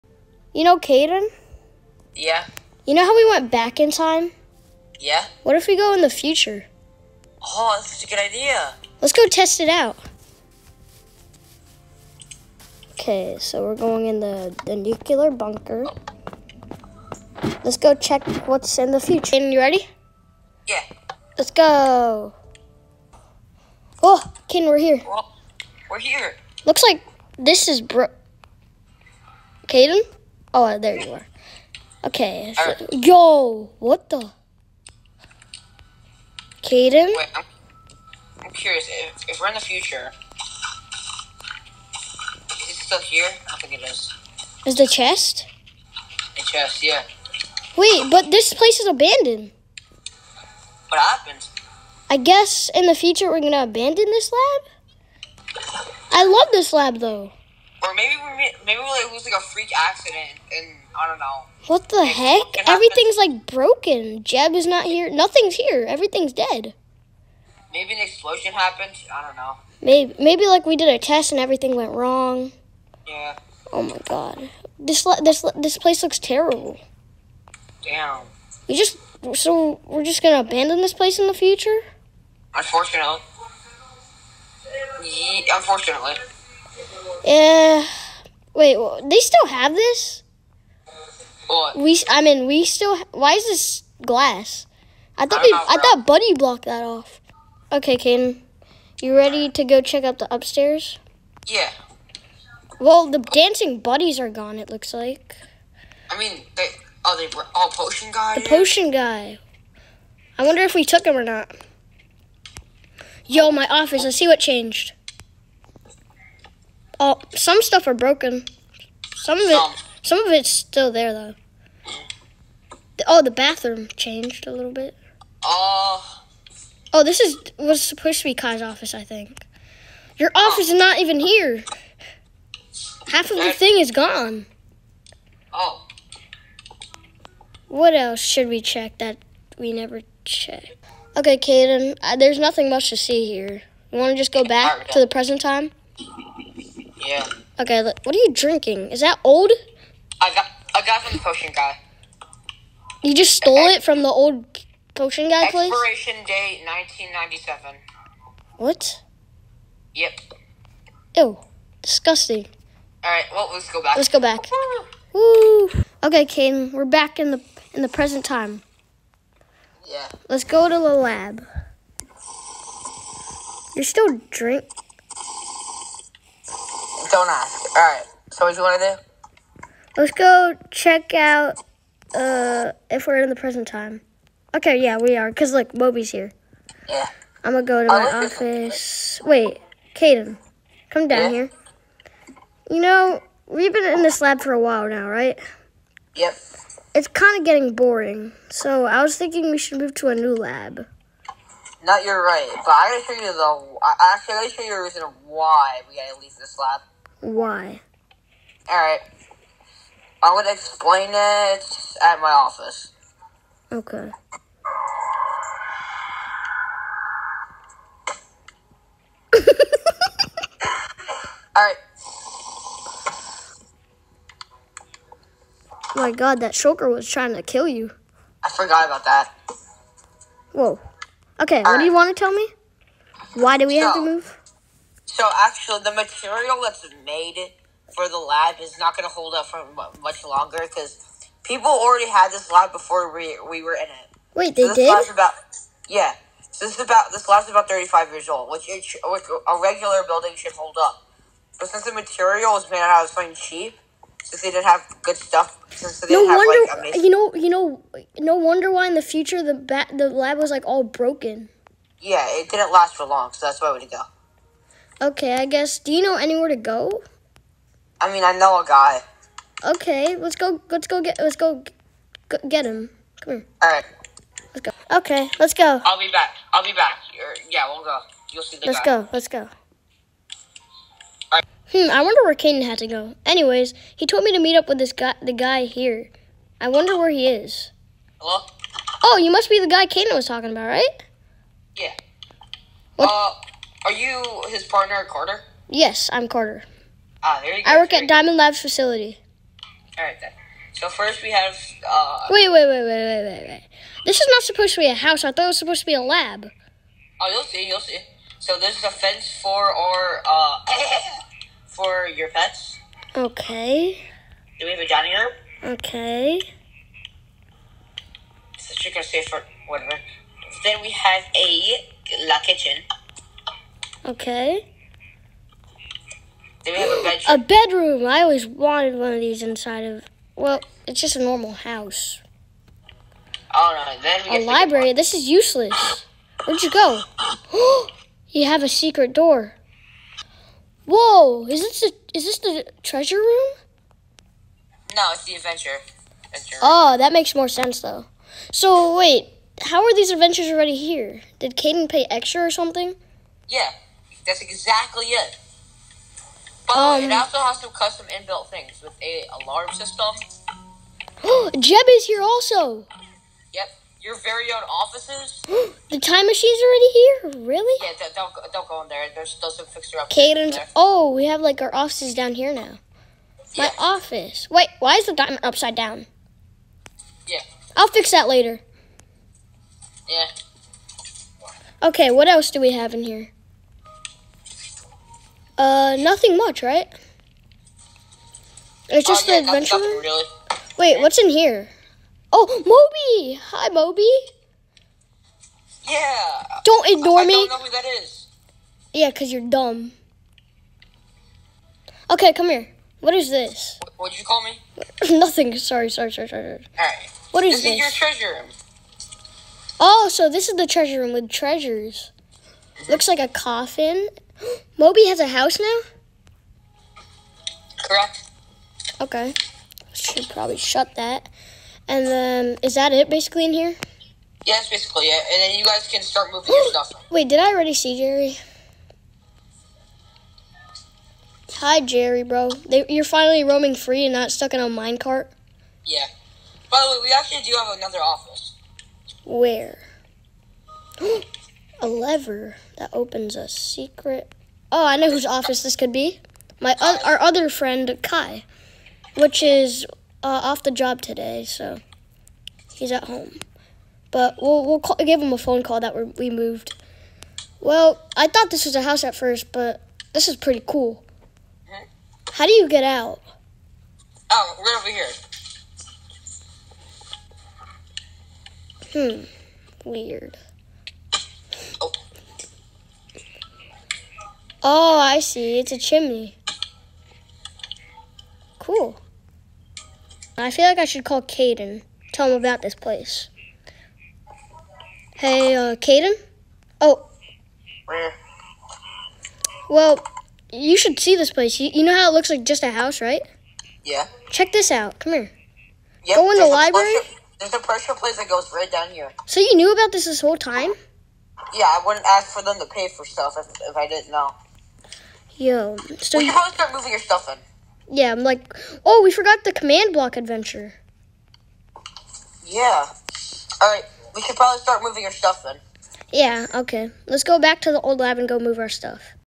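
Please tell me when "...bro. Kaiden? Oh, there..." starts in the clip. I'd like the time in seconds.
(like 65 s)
27 s.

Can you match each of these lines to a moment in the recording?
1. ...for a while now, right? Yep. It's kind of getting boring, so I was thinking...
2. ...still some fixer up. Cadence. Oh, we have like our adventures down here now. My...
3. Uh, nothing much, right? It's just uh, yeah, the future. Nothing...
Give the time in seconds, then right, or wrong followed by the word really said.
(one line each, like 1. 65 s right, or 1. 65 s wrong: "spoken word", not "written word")
1. 194 s right
2. 369 s wrong: "offices", not "adventures"
3. 385 s wrong: "adventure", not "future".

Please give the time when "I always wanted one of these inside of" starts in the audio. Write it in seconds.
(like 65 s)
328 s.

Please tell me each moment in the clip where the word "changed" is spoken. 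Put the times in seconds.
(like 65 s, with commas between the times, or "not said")
114 s, 123 s.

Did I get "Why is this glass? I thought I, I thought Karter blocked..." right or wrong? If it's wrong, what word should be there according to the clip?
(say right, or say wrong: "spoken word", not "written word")
wrong: "Buddy", not "Karter".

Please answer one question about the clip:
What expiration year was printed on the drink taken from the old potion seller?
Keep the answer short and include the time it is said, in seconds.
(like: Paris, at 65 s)
1997, at 156 s.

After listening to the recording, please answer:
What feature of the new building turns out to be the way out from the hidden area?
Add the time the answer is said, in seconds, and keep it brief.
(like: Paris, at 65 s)
A chimney, at 475 s.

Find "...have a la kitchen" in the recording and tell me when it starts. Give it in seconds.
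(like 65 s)
320 s.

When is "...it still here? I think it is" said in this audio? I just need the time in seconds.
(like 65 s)
42 s.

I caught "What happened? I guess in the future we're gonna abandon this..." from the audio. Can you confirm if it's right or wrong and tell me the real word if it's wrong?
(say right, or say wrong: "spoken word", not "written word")
right.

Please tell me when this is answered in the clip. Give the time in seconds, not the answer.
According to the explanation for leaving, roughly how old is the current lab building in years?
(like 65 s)
247 s.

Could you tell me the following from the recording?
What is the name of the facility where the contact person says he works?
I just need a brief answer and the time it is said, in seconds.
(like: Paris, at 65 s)
Diamond Labs, at 298 s.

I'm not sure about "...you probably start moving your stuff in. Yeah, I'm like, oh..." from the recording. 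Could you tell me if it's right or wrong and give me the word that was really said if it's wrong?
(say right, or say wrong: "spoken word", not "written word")
right.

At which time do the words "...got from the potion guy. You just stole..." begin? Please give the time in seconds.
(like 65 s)
150 s.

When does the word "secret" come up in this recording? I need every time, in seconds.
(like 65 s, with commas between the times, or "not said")
338 s, 443 s.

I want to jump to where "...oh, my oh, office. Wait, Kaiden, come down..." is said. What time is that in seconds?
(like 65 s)
187 s.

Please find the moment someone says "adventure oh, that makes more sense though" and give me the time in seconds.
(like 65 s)
346 s.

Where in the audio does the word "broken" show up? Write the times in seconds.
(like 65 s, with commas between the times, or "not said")
63 s, 117 s, 260 s.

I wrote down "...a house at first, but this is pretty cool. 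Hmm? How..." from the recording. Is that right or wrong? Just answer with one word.
right.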